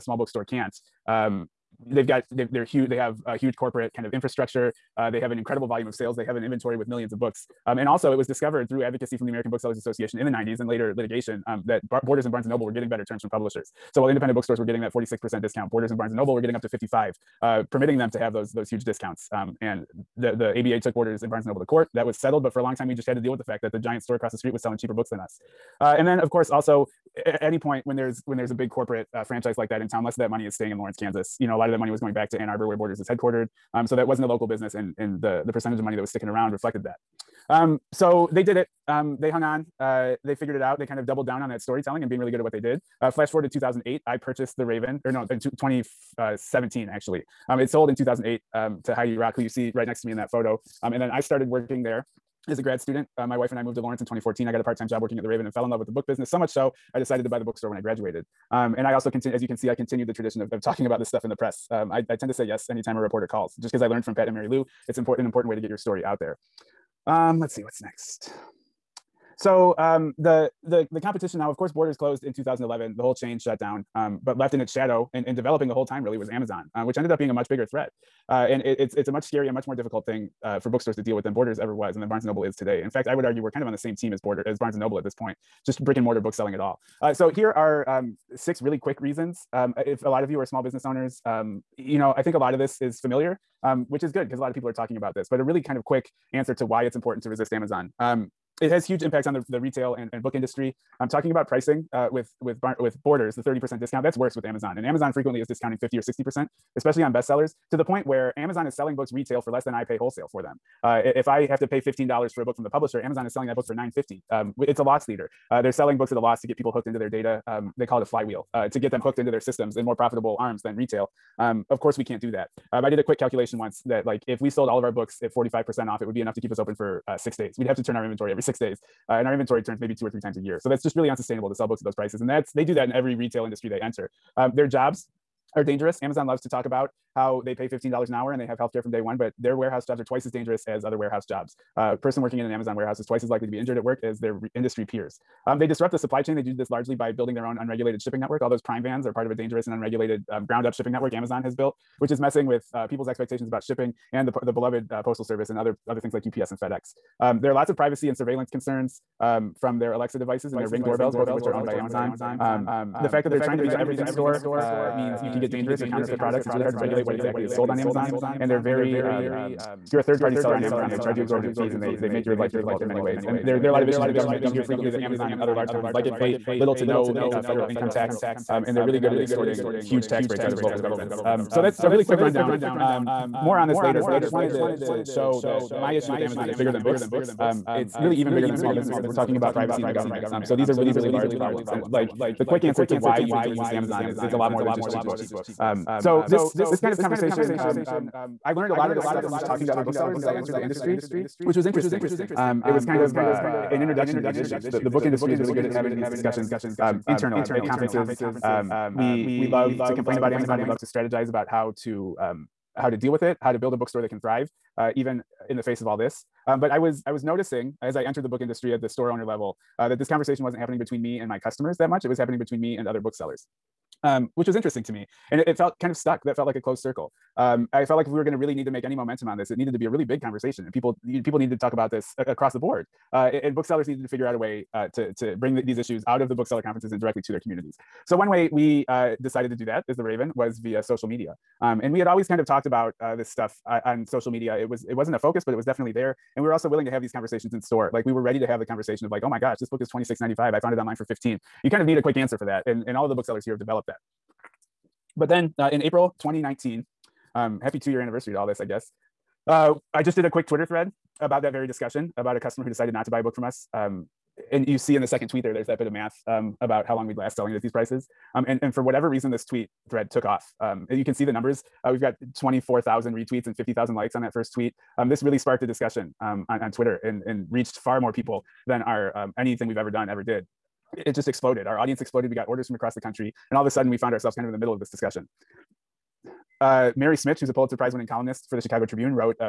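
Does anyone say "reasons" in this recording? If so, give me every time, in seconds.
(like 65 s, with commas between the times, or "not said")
88 s, 269 s.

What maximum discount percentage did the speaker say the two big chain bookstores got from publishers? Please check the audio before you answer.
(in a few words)
55.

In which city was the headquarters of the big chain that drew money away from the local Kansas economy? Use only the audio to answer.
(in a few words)
Ann Arbor.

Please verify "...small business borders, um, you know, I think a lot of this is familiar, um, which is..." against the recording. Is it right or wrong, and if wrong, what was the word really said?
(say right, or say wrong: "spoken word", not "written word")
wrong: "owners", not "borders".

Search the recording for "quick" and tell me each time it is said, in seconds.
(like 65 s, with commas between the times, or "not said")
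88 s, 95 s, 123 s, 182 s, 192 s, 252 s, 260 s.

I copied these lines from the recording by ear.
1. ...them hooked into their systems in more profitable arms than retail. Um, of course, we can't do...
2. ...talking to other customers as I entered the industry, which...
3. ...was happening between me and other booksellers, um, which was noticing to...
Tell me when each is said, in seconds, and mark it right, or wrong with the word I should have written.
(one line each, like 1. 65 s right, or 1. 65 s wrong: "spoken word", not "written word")
1. 118 s right
2. 199 s wrong: "booksellers", not "customers"
3. 222 s wrong: "interesting", not "noticing".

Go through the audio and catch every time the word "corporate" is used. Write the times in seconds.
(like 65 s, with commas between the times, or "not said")
3 s, 28 s.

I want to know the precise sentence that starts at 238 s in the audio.
So one way we uh, decided to do that as the Raven was via social media.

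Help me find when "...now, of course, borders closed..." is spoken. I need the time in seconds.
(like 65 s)
71 s.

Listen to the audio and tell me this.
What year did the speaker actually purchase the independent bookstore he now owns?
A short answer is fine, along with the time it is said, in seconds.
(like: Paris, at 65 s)
2017, at 45 s.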